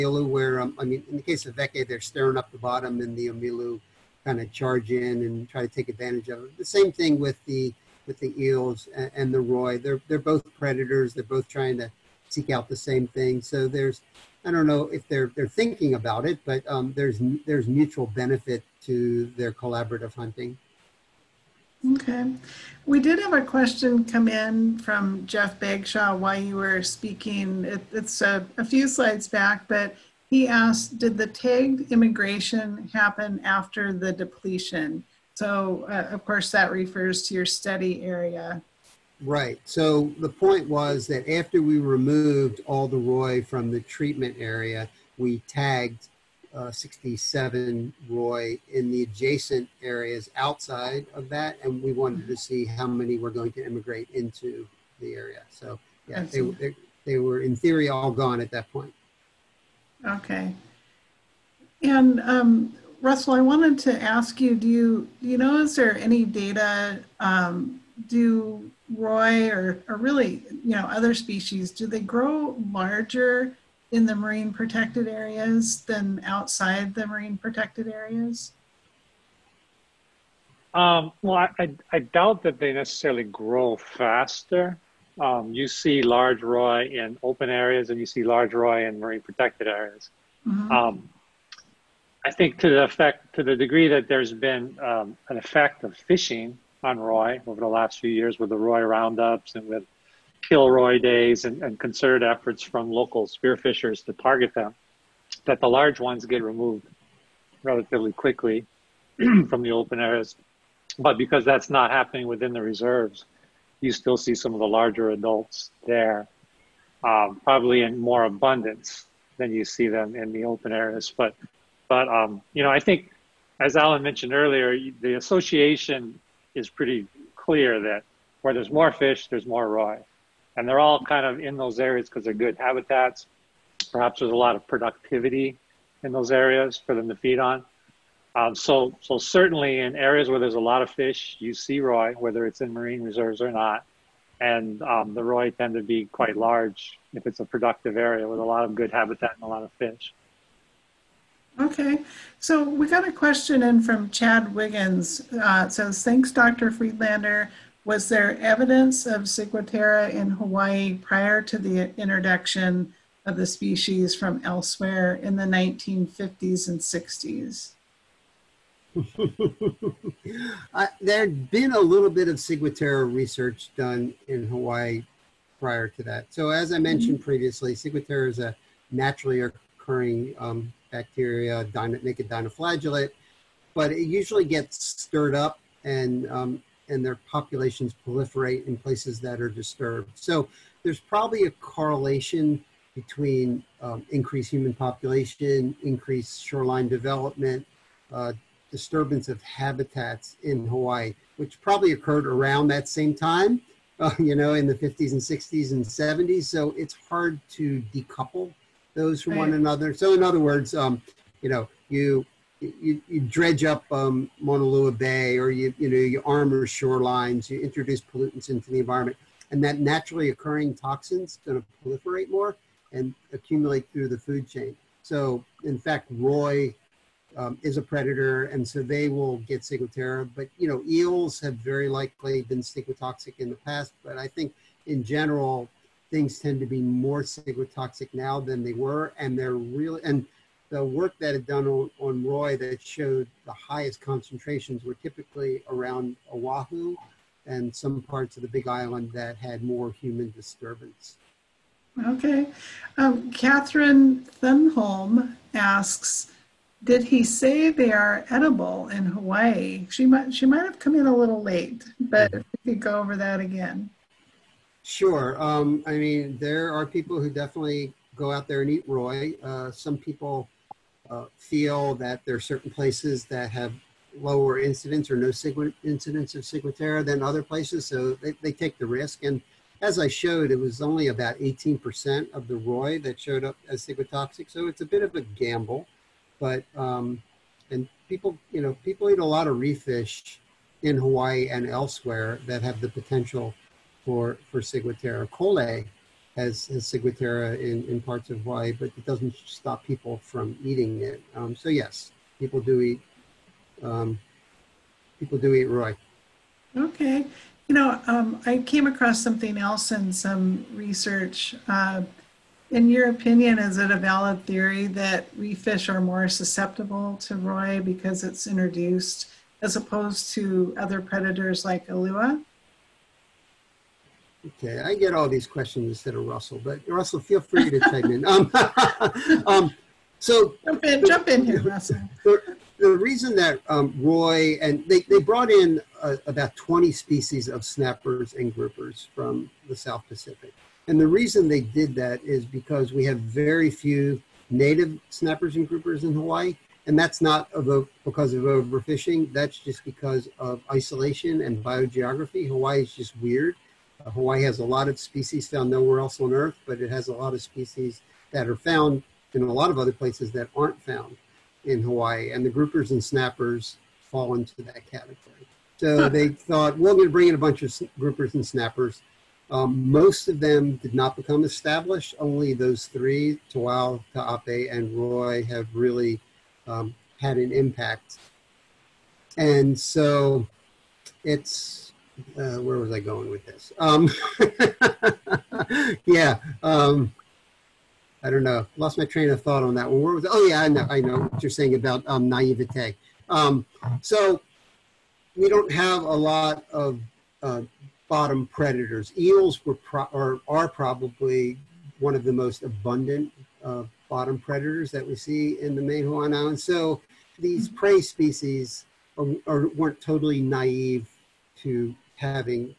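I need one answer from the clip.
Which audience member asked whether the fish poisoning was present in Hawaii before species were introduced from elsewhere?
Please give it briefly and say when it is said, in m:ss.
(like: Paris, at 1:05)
Chad Wiggins, at 2:34.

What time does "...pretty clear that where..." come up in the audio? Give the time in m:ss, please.
2:06.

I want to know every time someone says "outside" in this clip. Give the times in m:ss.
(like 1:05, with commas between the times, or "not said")
0:50, 1:16.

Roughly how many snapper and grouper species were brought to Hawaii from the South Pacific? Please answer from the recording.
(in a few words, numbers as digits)
20.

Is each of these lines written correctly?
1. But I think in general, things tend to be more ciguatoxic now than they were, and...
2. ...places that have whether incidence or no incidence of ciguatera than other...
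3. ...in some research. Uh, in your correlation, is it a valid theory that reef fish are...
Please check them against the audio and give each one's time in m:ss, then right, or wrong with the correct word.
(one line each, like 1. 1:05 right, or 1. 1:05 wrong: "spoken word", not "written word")
1. 3:54 right
2. 4:32 wrong: "lower", not "whether"
3. 5:09 wrong: "opinion", not "correlation".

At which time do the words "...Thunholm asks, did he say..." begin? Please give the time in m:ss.
4:14.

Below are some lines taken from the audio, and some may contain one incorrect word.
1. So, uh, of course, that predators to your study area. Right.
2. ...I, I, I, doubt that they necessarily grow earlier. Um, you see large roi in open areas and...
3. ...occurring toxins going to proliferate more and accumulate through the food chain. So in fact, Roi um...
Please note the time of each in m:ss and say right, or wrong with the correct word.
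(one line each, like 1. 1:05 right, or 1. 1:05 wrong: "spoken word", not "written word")
1. 0:35 wrong: "refers", not "predators"
2. 1:21 wrong: "faster", not "earlier"
3. 3:40 right.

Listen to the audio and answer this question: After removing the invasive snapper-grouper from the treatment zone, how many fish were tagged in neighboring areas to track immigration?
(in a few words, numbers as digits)
67.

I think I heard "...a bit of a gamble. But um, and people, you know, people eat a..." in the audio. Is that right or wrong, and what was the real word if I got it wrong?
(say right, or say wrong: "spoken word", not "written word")
right.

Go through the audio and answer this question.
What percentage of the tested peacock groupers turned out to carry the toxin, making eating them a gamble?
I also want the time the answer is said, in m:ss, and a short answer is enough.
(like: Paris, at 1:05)
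18%, at 4:41.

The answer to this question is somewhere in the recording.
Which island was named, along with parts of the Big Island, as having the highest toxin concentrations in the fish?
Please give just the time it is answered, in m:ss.
4:06.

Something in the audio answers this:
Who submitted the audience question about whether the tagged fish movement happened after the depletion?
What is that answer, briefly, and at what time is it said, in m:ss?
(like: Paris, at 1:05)
Jeff Bagshaw, at 0:25.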